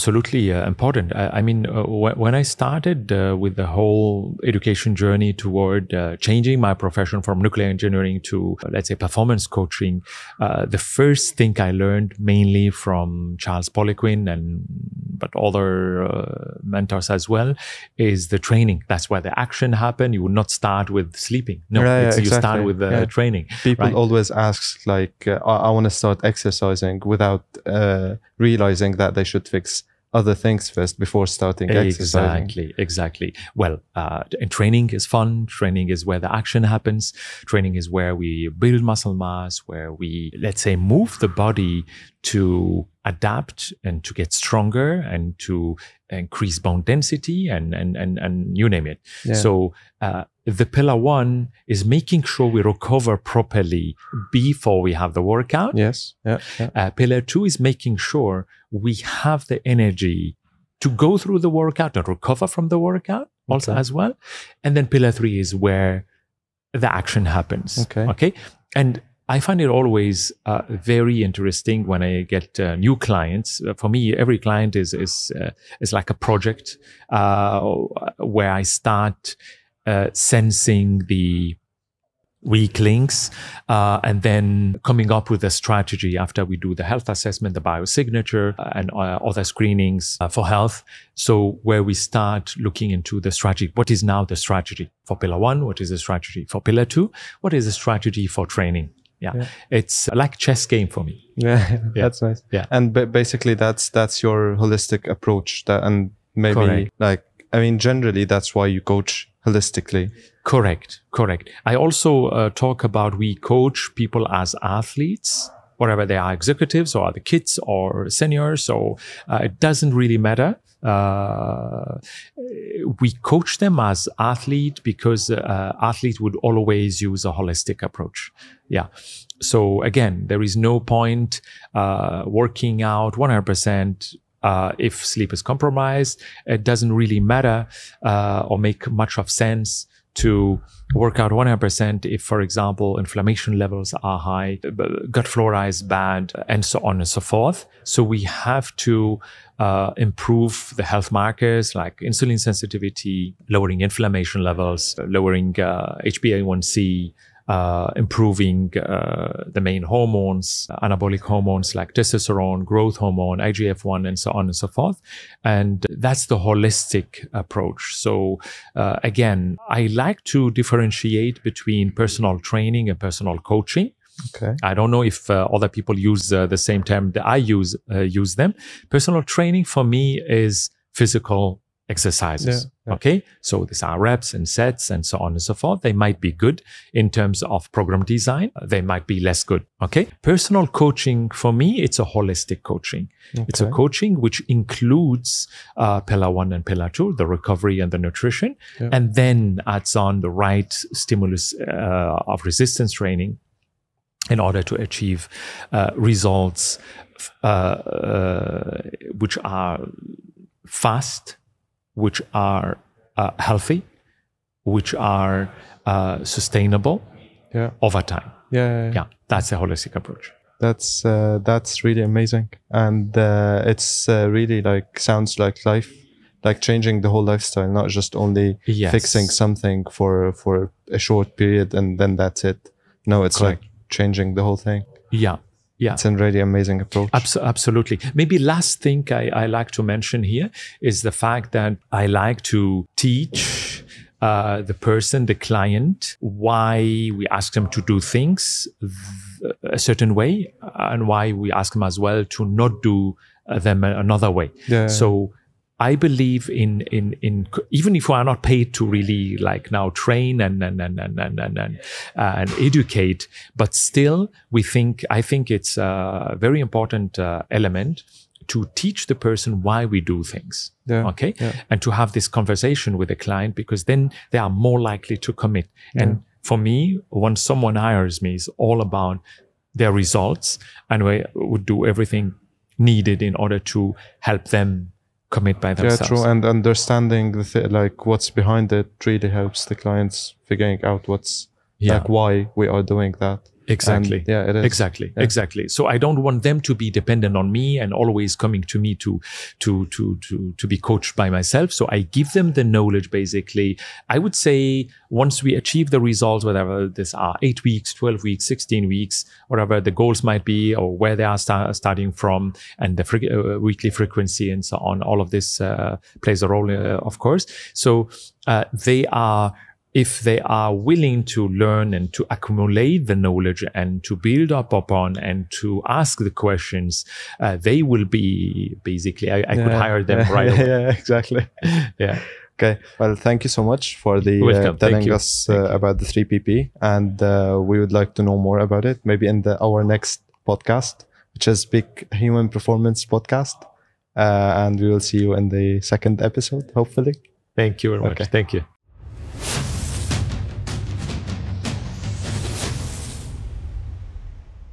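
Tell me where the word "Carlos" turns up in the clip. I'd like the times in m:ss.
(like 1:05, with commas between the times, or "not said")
not said.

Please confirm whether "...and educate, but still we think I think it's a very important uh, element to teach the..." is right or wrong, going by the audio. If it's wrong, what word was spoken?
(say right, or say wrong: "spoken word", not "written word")
right.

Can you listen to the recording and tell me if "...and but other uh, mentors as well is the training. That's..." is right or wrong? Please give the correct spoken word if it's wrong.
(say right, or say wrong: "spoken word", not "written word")
right.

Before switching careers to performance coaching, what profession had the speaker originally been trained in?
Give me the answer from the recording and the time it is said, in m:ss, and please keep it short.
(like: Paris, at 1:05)
nuclear engineering, at 0:07.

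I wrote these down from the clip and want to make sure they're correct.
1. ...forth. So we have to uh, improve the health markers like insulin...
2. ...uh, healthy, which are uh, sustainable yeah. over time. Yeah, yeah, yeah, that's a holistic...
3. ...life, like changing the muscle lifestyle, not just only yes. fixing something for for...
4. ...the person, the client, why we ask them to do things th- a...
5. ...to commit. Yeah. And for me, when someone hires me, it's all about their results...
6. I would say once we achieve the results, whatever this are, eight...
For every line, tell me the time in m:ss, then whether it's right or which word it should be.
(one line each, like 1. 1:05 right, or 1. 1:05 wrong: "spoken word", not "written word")
1. 2:27 right
2. 3:33 right
3. 3:45 wrong: "whole", not "muscle"
4. 4:04 right
5. 4:35 right
6. 5:04 right.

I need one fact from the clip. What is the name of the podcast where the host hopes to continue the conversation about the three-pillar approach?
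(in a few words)
Big Human Performance Podcast.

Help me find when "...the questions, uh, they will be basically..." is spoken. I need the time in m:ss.
5:26.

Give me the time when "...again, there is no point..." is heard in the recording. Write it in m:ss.
2:09.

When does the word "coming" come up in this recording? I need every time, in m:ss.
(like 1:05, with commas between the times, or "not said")
1:24, 4:58.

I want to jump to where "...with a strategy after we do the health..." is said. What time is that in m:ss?
1:25.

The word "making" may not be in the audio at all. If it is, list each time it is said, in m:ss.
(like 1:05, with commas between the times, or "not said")
0:51, 0:57.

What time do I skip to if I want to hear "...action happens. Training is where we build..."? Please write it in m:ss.
0:36.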